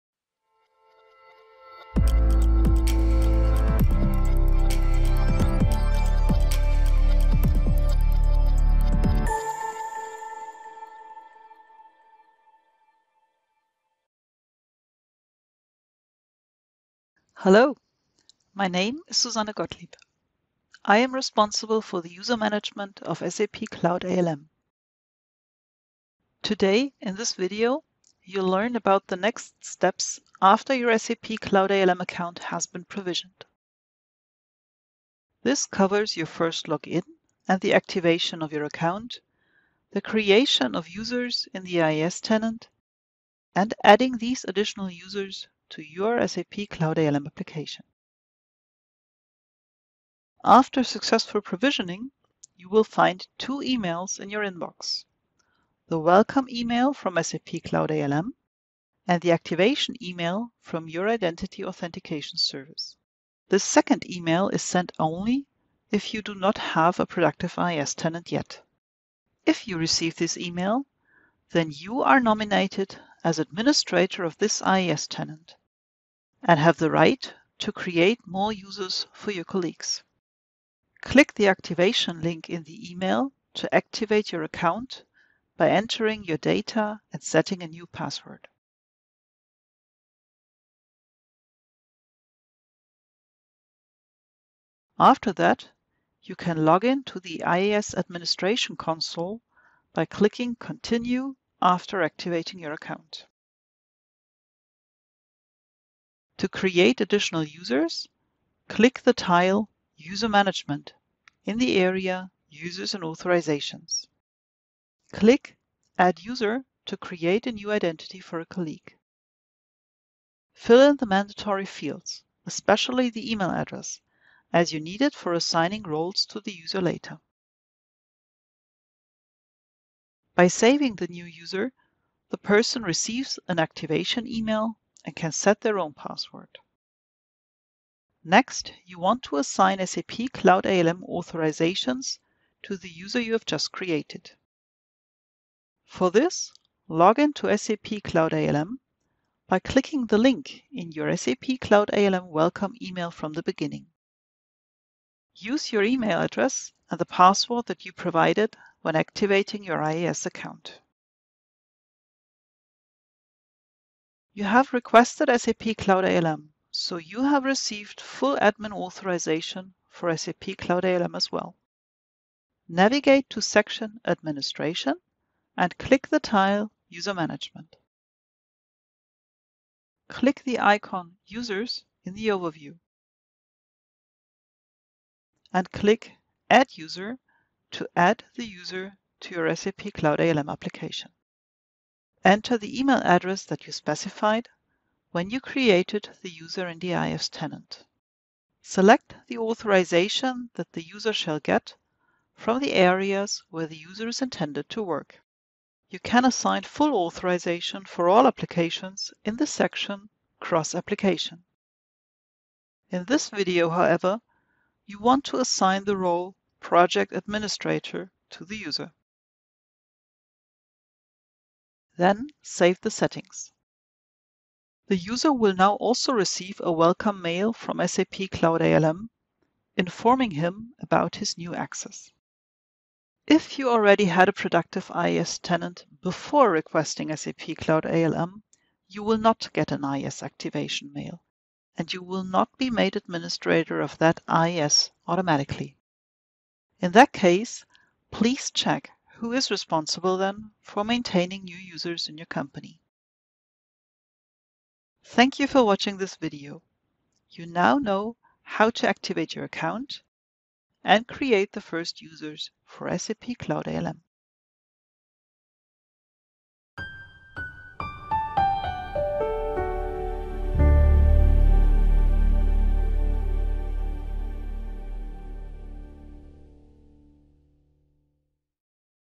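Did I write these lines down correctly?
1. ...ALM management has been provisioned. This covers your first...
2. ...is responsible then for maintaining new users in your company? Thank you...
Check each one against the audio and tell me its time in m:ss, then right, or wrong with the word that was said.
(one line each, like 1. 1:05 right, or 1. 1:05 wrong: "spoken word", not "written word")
1. 0:31 wrong: "account", not "management"
2. 4:09 right.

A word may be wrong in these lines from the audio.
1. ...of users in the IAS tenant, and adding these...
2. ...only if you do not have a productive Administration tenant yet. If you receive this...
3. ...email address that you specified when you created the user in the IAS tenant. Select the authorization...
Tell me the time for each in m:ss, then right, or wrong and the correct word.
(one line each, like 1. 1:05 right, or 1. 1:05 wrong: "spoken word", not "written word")
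1. 0:40 right
2. 1:04 wrong: "IAS", not "Administration"
3. 3:12 right.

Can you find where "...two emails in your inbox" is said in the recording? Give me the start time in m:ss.
0:53.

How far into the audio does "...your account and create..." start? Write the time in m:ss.
4:19.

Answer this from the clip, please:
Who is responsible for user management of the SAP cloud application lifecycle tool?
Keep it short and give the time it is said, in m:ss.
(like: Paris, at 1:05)
Susanne Gottlieb, at 0:19.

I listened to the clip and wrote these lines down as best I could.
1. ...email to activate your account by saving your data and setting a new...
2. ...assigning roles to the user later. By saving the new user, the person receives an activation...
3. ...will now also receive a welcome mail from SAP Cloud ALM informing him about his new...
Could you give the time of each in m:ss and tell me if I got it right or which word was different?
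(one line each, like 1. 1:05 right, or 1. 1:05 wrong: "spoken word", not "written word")
1. 1:22 wrong: "entering", not "saving"
2. 2:05 right
3. 3:45 right.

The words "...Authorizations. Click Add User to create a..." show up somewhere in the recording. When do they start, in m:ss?
1:53.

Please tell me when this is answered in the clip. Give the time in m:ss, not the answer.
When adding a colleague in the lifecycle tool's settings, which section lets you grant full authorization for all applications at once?
3:30.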